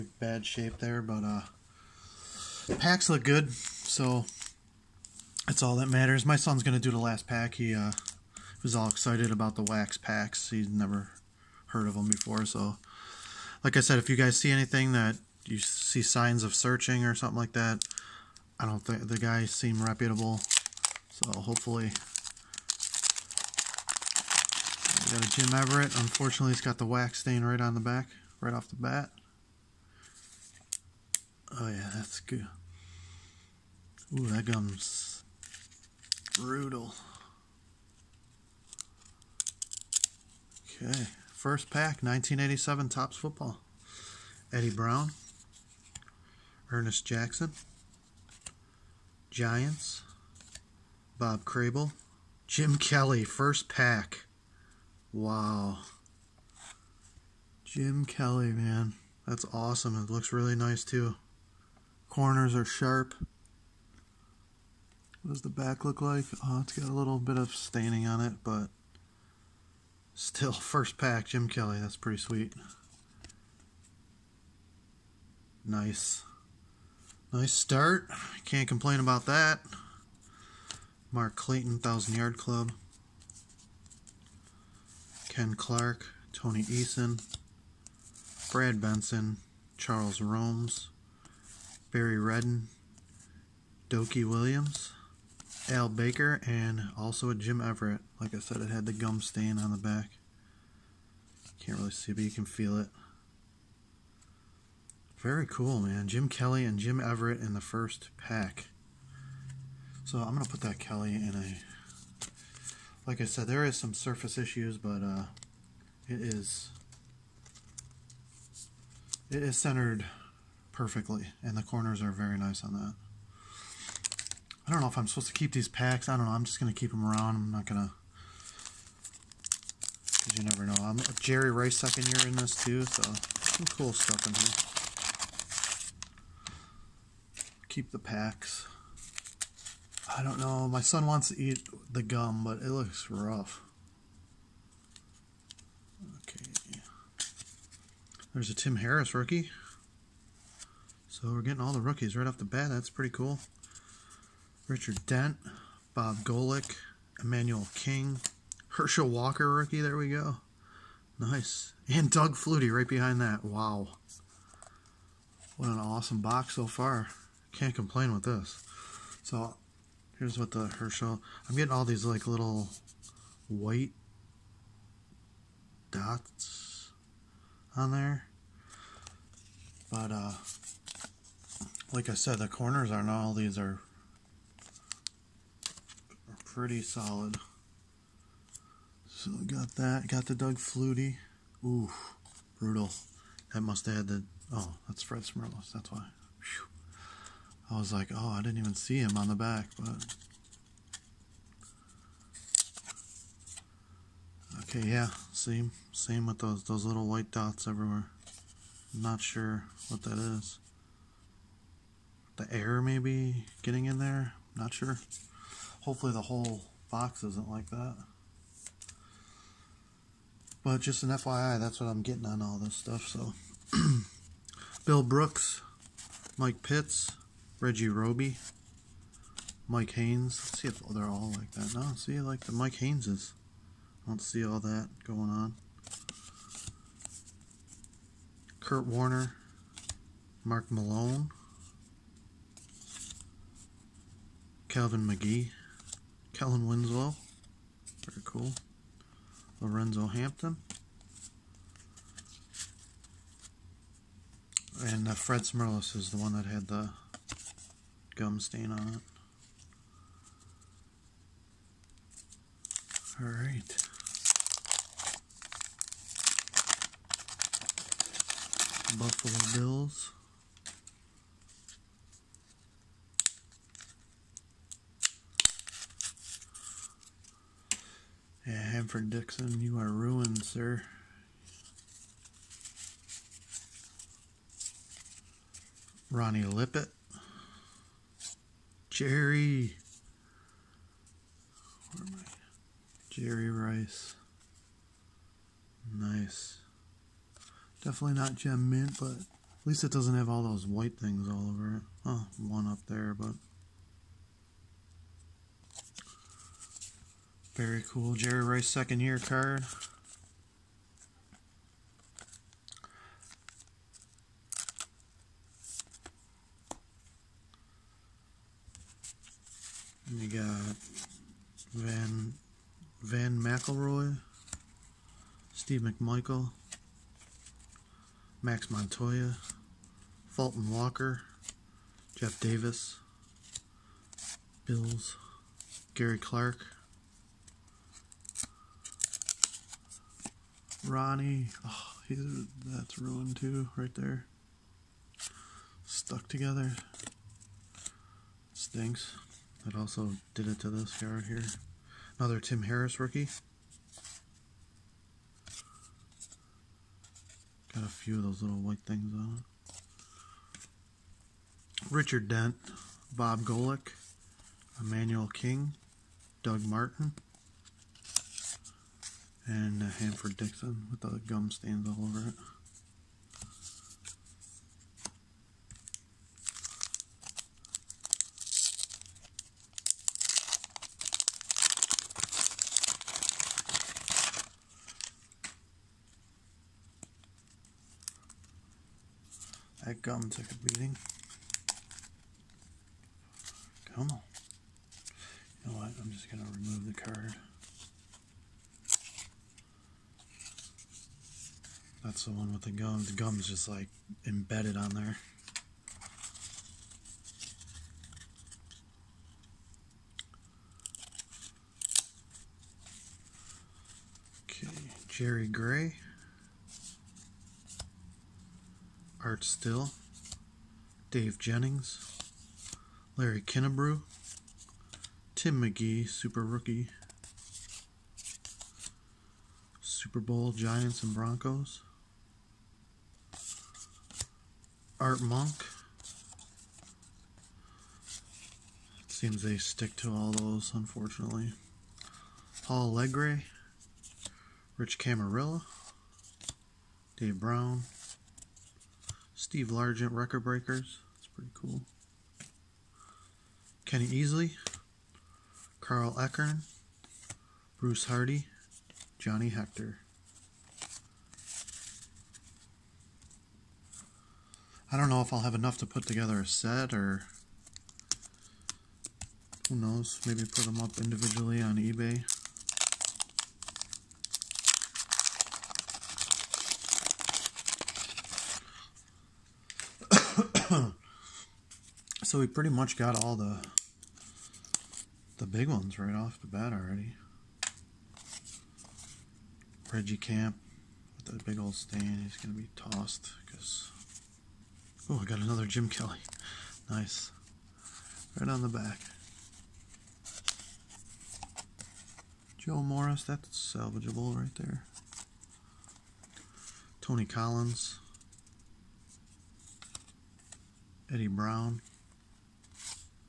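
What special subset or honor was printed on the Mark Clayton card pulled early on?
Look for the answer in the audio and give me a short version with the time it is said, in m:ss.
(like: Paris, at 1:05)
Thousand Yard Club, at 1:21.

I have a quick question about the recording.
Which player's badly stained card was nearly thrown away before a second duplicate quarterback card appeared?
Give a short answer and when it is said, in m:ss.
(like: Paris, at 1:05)
Reggie Camp, at 8:09.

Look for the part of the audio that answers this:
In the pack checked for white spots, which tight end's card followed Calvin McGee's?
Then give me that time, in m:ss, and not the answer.
4:06.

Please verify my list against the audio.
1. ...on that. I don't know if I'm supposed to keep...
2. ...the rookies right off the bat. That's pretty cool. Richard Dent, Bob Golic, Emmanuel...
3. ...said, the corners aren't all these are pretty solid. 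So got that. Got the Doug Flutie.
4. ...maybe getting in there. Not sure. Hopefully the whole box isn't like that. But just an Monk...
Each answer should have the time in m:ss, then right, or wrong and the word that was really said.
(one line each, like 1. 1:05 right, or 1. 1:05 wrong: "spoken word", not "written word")
1. 2:02 right
2. 2:31 right
3. 3:02 right
4. 3:32 wrong: "FYI", not "Monk".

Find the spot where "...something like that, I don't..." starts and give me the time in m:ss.
0:17.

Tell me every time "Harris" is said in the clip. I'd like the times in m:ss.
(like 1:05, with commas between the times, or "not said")
2:28, 5:52.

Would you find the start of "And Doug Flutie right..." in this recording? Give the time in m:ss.
2:41.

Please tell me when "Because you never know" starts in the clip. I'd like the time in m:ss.
2:10.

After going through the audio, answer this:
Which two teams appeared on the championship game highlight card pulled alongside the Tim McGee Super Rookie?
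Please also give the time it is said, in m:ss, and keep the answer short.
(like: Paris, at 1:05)
Giants and Broncos, at 7:10.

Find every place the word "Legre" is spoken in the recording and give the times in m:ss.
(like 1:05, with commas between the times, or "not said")
7:22.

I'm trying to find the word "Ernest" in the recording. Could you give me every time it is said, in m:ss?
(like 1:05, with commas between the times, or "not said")
0:46.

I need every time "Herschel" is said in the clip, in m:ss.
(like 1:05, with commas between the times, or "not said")
2:38, 2:50.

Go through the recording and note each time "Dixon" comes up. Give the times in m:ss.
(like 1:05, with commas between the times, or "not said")
4:39, 6:10.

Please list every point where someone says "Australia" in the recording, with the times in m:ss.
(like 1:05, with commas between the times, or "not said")
not said.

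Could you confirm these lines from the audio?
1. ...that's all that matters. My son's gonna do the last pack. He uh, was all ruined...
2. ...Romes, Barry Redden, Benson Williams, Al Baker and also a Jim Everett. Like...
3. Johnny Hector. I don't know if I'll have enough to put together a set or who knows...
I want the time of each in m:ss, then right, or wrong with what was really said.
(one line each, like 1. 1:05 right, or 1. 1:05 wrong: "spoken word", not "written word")
1. 0:05 wrong: "excited", not "ruined"
2. 1:30 wrong: "Dokie", not "Benson"
3. 7:39 right.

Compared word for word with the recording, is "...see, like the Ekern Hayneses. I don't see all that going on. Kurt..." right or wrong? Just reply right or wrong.
wrong.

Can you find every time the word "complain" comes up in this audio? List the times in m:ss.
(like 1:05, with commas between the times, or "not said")
1:18, 2:47.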